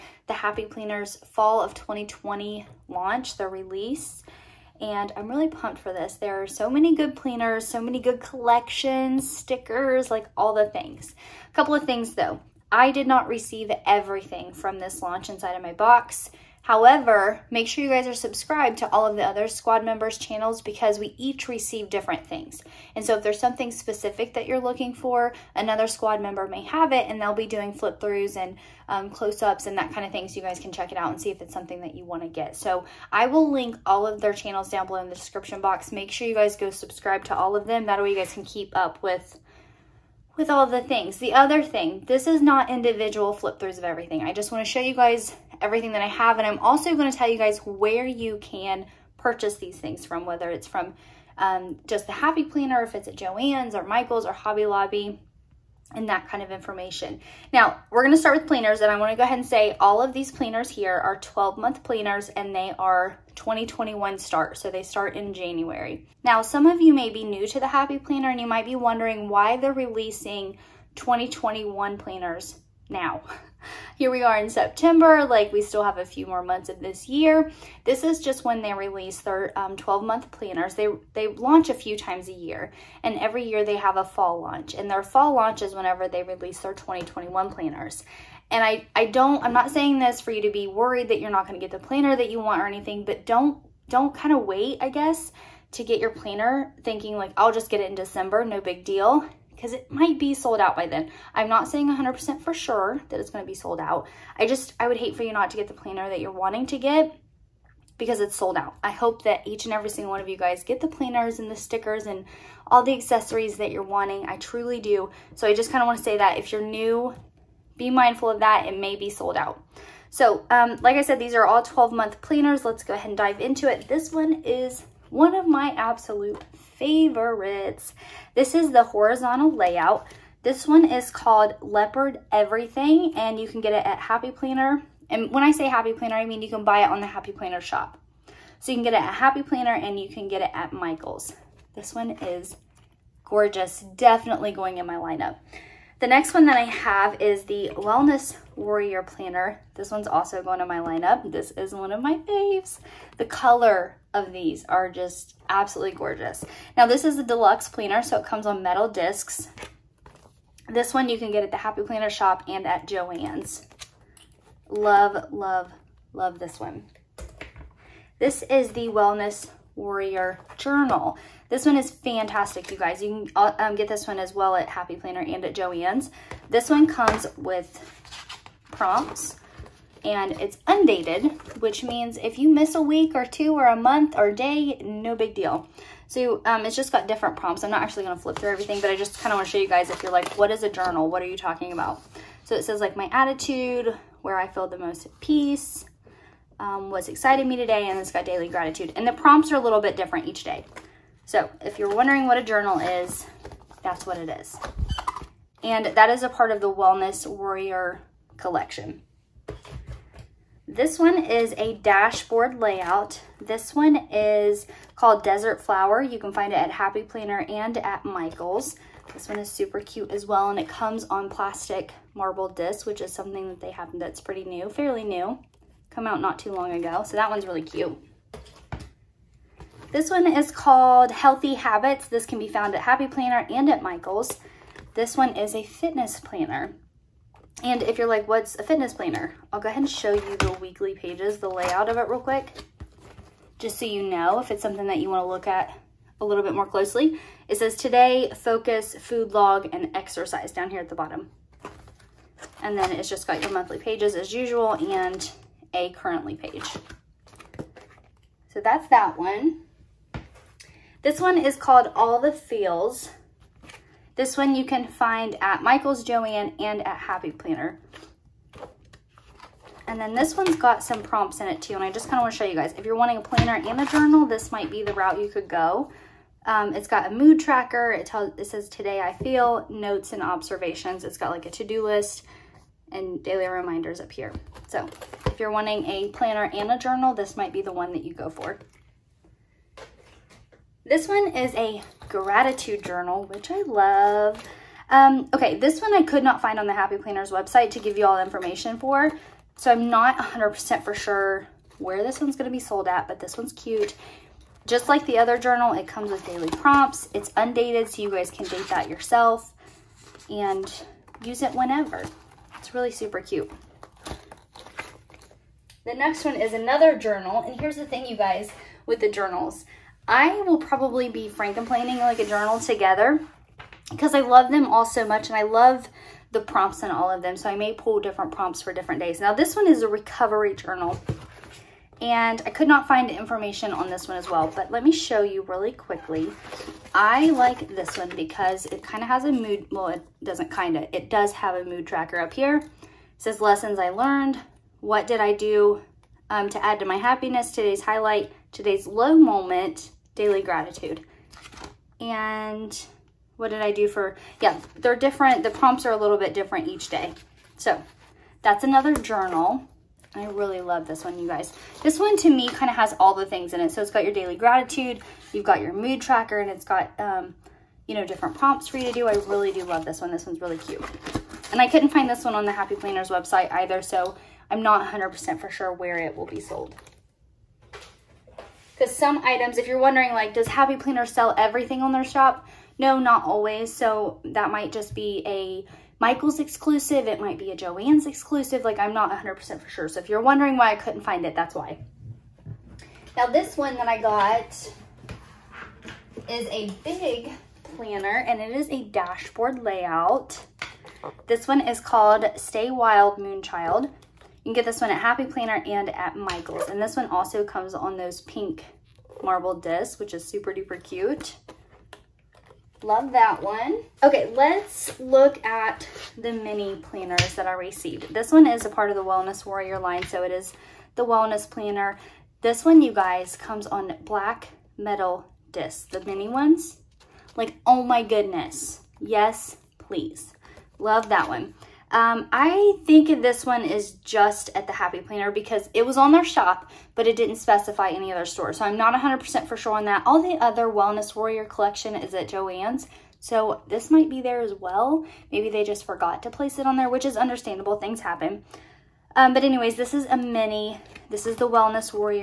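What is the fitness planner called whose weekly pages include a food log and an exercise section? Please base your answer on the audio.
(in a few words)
Healthy Habits.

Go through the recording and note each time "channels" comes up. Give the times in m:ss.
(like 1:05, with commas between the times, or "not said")
0:20, 0:34.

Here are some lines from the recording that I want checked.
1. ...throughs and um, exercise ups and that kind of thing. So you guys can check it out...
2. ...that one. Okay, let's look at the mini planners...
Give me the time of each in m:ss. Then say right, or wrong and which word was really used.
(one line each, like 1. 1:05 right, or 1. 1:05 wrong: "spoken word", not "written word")
1. 0:28 wrong: "close", not "exercise"
2. 6:53 right.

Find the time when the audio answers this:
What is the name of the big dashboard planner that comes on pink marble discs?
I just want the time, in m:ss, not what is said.
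6:42.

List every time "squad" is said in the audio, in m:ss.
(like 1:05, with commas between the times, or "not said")
0:19, 0:25.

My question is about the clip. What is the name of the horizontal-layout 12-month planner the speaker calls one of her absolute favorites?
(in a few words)
Leopard Everything.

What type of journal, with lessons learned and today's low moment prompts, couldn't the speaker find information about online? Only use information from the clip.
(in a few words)
recovery journal.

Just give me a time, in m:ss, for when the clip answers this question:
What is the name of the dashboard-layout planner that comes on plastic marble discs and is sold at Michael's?
3:35.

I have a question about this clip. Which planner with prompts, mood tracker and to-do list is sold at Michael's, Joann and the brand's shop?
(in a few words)
All the Feels.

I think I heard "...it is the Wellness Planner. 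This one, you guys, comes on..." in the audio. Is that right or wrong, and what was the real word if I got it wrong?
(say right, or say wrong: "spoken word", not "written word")
right.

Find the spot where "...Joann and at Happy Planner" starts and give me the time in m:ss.
4:26.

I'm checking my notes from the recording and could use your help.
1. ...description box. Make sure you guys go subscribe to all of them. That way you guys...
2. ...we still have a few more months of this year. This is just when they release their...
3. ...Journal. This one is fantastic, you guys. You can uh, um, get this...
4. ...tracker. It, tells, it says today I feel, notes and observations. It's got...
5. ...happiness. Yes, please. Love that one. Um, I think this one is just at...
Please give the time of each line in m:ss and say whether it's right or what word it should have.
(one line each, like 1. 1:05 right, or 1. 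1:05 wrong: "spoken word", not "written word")
1. 0:35 right
2. 1:15 right
3. 2:50 right
4. 4:37 right
5. 7:08 wrong: "goodness", not "happiness".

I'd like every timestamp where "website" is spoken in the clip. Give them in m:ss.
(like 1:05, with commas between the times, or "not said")
4:57, 6:13.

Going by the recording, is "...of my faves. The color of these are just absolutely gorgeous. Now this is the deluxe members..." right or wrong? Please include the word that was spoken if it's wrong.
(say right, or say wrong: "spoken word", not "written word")
wrong: "planner", not "members".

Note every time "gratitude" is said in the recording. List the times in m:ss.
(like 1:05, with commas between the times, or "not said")
3:18, 4:52, 5:50, 6:04.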